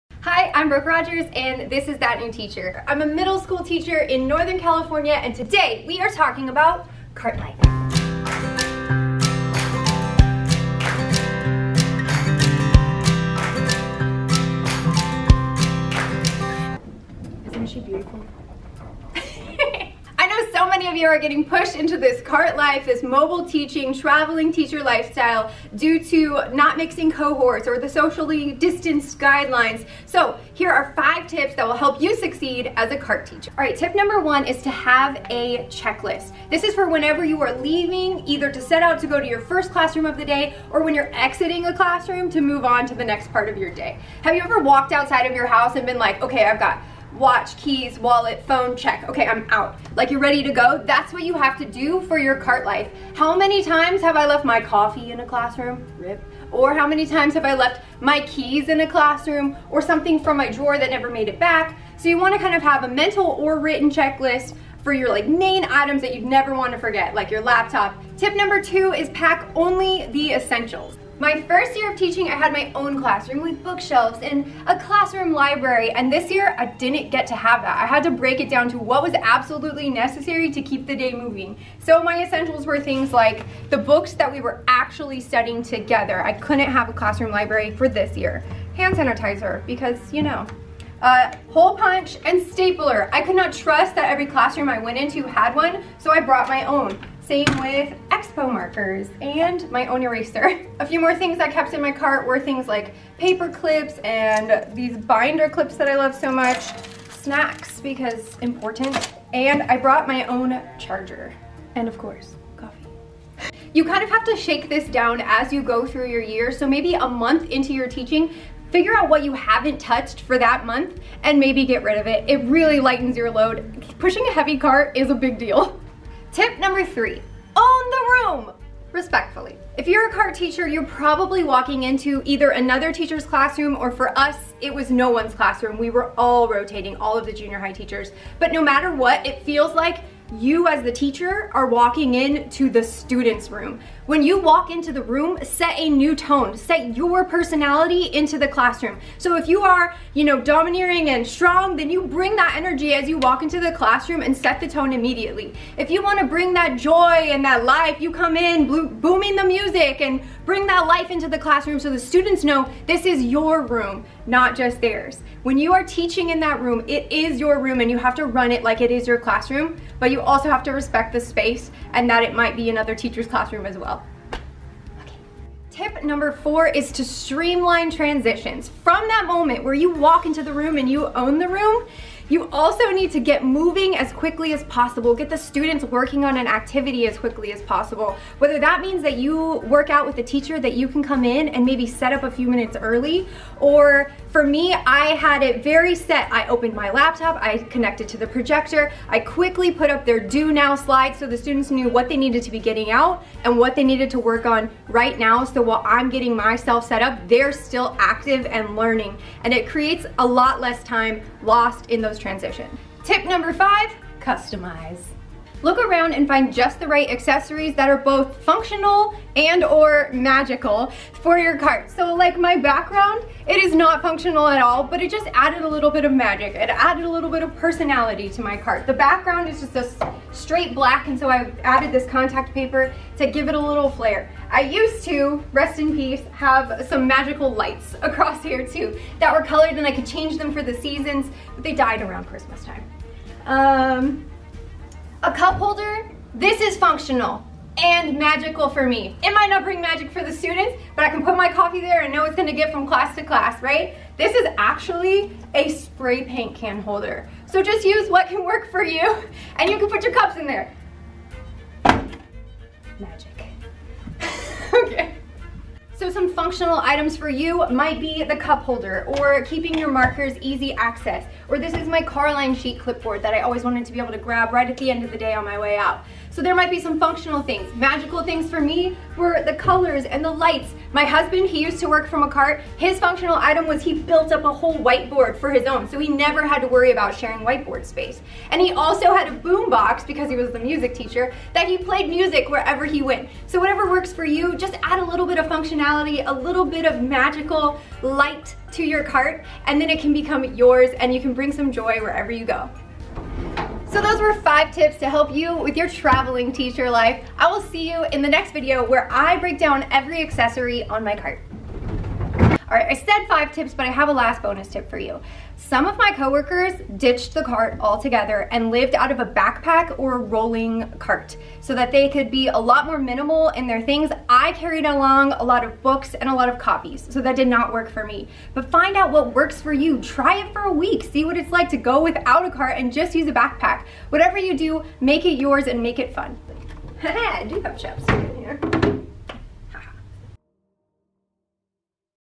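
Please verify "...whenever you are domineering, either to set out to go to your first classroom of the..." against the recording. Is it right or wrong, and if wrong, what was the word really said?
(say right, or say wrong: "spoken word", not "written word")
wrong: "leaving", not "domineering".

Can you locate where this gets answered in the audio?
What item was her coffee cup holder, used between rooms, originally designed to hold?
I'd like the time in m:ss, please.
4:15.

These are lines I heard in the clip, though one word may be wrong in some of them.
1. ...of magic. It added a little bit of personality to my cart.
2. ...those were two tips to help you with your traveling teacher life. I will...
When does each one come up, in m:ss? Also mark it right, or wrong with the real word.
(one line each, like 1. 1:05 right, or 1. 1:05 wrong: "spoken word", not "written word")
1. 3:46 right
2. 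5:04 wrong: "five", not "two".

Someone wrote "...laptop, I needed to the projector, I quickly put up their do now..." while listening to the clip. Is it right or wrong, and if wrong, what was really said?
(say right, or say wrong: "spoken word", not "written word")
wrong: "connected", not "needed".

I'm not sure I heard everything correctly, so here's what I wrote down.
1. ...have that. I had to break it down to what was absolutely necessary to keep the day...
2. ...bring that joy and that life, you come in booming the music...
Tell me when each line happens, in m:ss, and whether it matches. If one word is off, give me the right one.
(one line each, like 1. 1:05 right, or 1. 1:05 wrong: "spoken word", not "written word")
1. 1:17 right
2. 2:36 right.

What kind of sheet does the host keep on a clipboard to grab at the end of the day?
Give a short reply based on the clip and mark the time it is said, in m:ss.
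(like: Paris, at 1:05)
Carline sheet, at 4:32.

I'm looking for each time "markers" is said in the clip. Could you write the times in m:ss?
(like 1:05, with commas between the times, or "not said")
1:38, 4:29.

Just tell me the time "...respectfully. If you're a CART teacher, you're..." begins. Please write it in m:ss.
2:08.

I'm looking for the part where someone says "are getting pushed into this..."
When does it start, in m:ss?
0:21.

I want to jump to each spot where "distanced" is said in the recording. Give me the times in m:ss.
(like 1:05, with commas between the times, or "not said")
0:28.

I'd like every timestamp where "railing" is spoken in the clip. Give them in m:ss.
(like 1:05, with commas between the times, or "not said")
not said.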